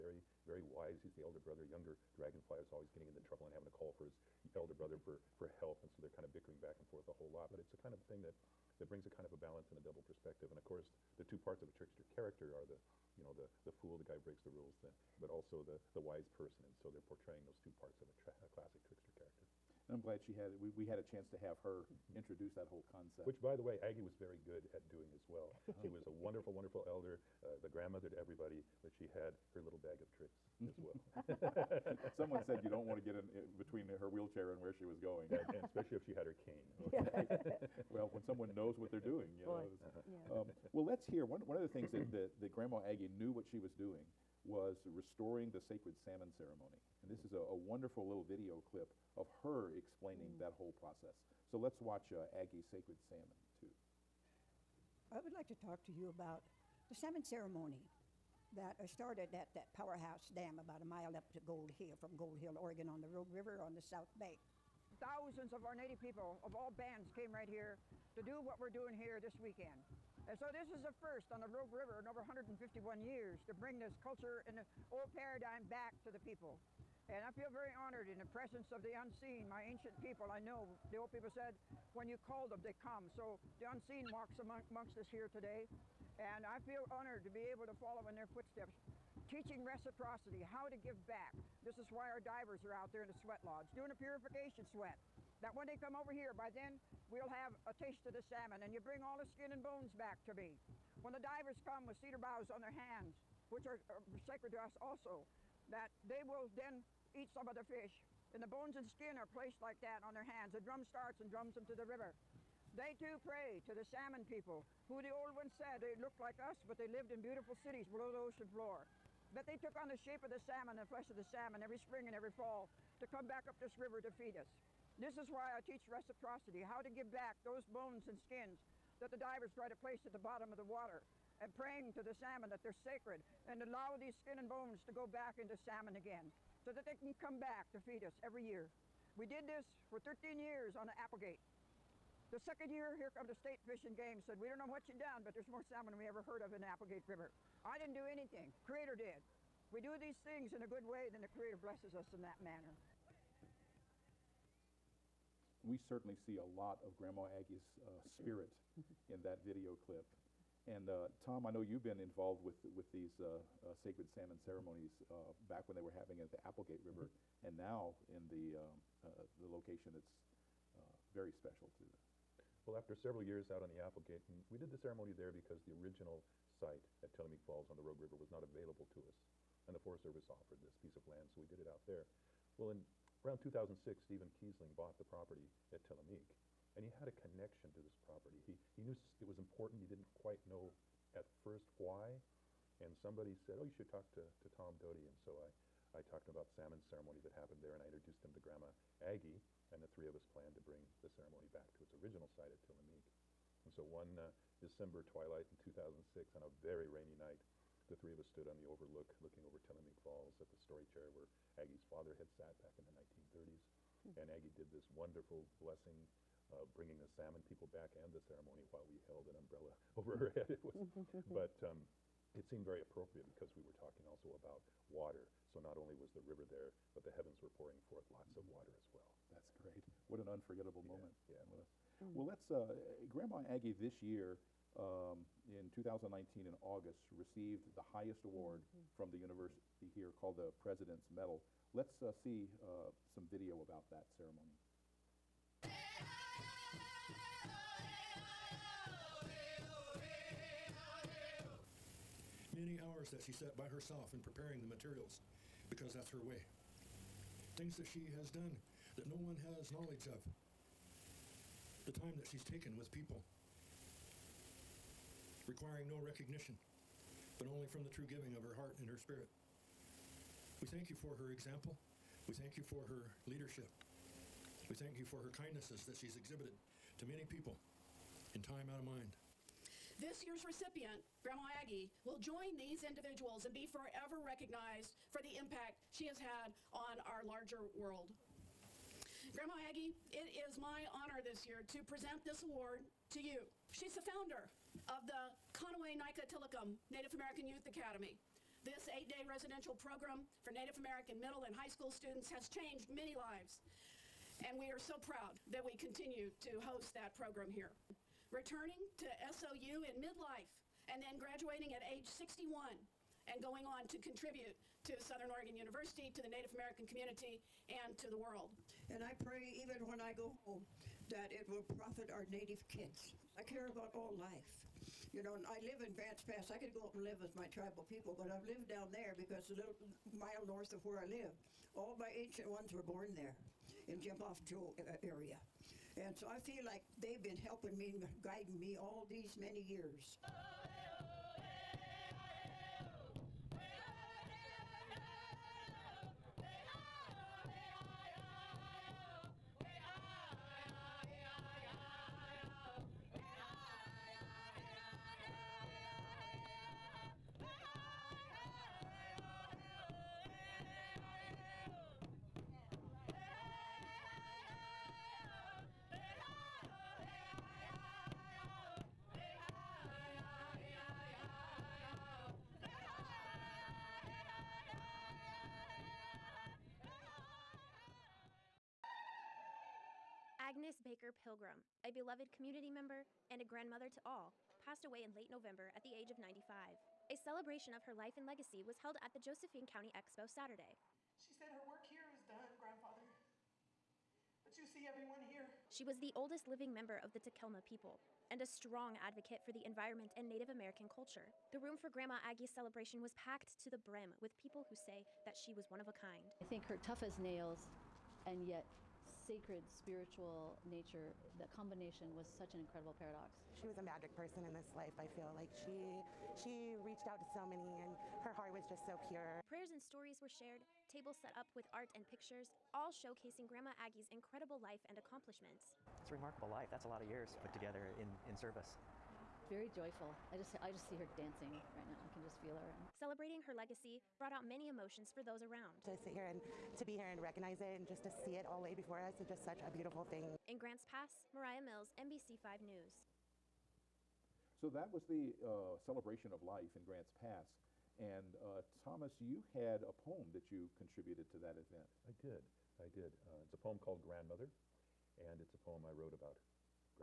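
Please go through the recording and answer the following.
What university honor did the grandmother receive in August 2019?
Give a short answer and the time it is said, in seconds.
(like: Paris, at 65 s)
President's Medal, at 240 s.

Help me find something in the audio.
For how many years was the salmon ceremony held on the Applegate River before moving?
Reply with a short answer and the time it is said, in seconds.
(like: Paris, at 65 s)
13, at 139 s.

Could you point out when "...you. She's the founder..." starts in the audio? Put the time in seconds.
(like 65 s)
293 s.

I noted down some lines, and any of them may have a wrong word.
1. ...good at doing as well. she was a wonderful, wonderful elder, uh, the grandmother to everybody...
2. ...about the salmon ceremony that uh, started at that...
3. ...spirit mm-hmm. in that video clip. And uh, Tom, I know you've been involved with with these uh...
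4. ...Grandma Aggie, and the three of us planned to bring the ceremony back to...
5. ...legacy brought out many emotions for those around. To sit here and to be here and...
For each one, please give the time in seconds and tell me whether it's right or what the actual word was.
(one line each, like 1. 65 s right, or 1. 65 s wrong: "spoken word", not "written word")
1. 24 s right
2. 56 s right
3. 158 s right
4. 198 s right
5. 433 s right.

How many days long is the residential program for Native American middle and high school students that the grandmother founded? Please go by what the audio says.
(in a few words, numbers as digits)
8.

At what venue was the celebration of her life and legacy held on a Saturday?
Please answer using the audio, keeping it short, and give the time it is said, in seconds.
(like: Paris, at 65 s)
Josephine County Expo, at 389 s.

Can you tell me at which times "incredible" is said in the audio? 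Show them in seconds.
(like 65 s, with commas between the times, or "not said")
412 s, 424 s.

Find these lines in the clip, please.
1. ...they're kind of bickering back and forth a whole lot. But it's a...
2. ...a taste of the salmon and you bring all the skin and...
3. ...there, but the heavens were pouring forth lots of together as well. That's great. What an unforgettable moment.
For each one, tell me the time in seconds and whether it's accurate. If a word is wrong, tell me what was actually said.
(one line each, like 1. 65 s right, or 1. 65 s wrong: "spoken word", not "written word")
1. 6 s right
2. 97 s right
3. 226 s wrong: "water", not "together".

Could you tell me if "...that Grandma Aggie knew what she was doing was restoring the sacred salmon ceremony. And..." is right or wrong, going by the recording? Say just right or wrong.
right.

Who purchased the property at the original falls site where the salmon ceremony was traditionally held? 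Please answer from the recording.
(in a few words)
Stephen Kiesling.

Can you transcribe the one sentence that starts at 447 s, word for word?
And uh, Thomas, you had a poem that you contributed to that event.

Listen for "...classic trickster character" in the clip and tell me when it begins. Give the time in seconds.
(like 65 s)
18 s.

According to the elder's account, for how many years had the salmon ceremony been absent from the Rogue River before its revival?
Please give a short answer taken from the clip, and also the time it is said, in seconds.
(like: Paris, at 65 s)
151 years, at 72 s.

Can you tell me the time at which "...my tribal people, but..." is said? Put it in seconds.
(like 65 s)
327 s.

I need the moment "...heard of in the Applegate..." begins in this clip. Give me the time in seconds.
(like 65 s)
146 s.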